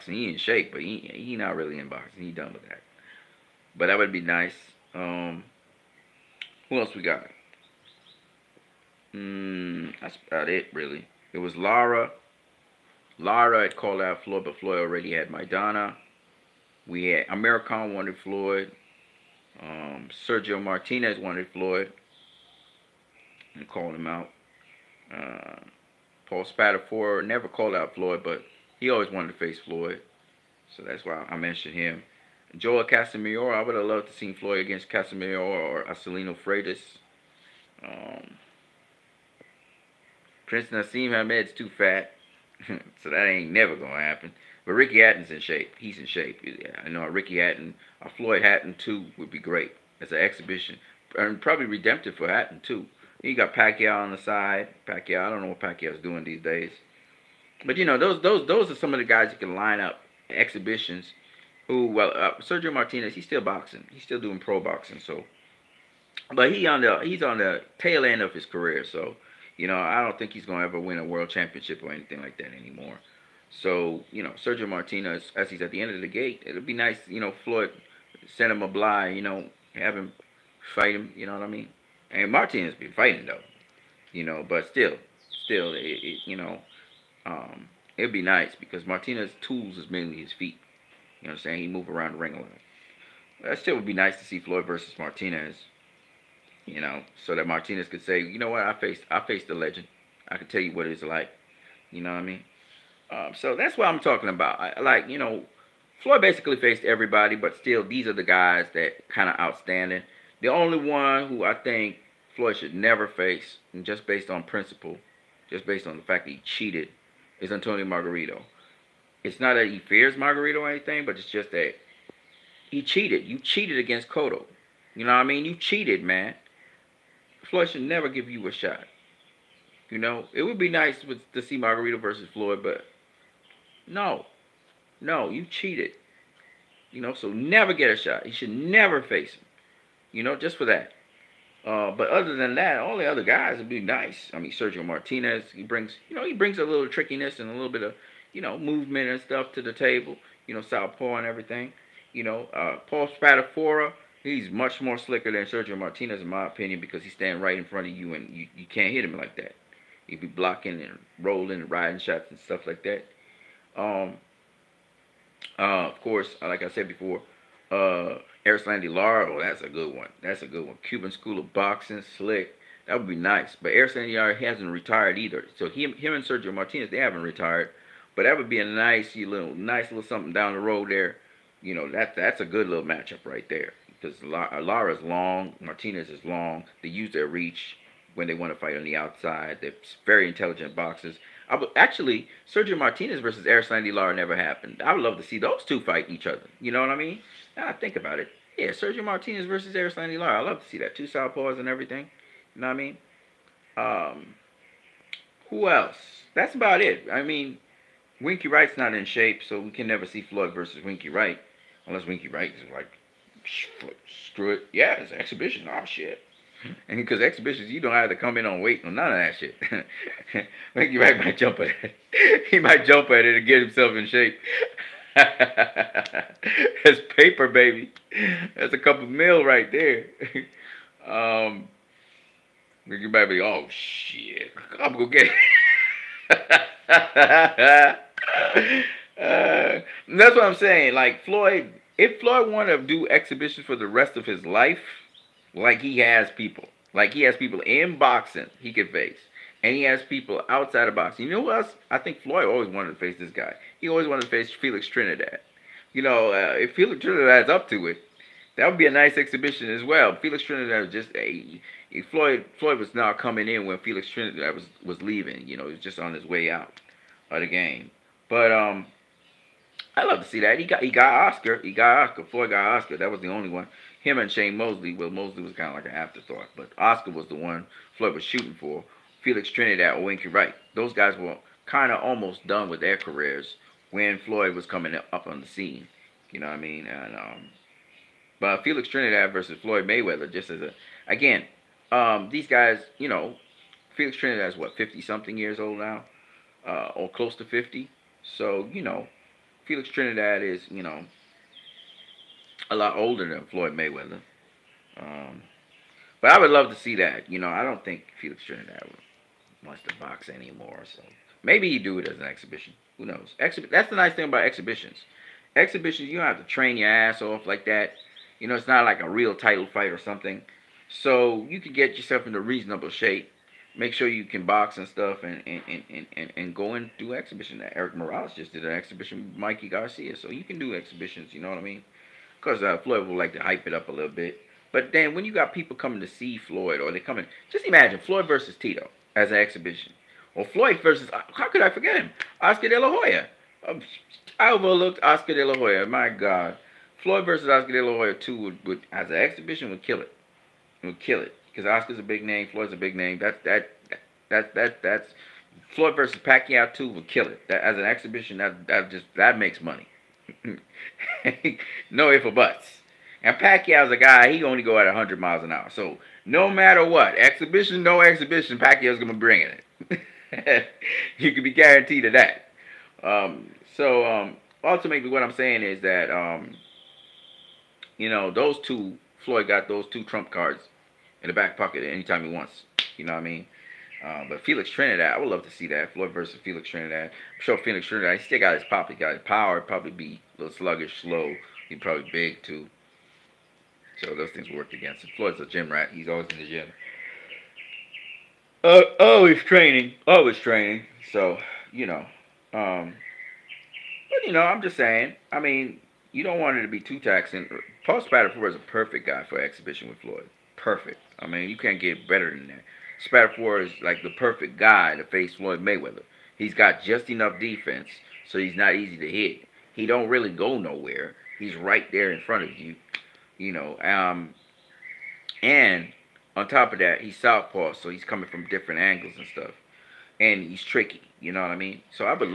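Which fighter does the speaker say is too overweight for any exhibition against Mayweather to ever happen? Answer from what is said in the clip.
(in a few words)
Prince Naseem Hamed.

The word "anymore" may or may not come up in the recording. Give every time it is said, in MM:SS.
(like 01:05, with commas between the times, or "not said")
01:12, 05:10.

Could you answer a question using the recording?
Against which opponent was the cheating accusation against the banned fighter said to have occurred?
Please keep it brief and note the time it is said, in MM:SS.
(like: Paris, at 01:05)
Cotto, at 02:04.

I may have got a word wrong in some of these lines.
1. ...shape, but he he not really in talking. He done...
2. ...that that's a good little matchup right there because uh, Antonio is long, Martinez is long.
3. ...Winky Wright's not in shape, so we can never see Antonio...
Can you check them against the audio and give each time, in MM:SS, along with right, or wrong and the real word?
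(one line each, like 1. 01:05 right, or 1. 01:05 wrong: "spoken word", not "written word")
1. 00:00 wrong: "boxing", not "talking"
2. 03:01 wrong: "Lara", not "Antonio"
3. 03:28 wrong: "Floyd", not "Antonio".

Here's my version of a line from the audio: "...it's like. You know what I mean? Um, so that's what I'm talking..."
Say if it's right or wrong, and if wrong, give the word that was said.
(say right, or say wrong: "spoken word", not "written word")
right.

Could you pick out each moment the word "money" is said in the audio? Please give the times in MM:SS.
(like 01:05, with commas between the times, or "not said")
05:59.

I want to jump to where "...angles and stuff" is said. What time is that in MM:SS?
07:08.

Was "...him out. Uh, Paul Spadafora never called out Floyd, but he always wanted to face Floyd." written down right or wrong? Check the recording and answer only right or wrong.
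right.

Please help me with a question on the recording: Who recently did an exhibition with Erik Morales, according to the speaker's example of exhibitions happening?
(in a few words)
Mikey Garcia.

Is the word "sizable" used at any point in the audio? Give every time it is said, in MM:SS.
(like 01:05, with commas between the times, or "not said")
not said.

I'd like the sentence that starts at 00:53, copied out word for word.
You got Pacquiao on the side.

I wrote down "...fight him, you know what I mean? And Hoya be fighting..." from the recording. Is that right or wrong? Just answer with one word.
wrong.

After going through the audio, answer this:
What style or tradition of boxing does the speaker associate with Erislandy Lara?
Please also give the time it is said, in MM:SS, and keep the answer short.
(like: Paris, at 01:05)
Cuban School of Boxing, at 02:50.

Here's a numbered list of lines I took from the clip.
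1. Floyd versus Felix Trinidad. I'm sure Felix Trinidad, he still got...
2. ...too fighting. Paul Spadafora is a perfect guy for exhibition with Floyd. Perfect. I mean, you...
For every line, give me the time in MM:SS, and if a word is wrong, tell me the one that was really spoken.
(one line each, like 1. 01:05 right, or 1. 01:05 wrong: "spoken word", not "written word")
1. 06:25 right
2. 06:46 wrong: "taxing", not "fighting".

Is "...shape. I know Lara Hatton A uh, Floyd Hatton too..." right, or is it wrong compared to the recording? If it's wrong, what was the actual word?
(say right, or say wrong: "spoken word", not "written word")
wrong: "Ricky", not "Lara".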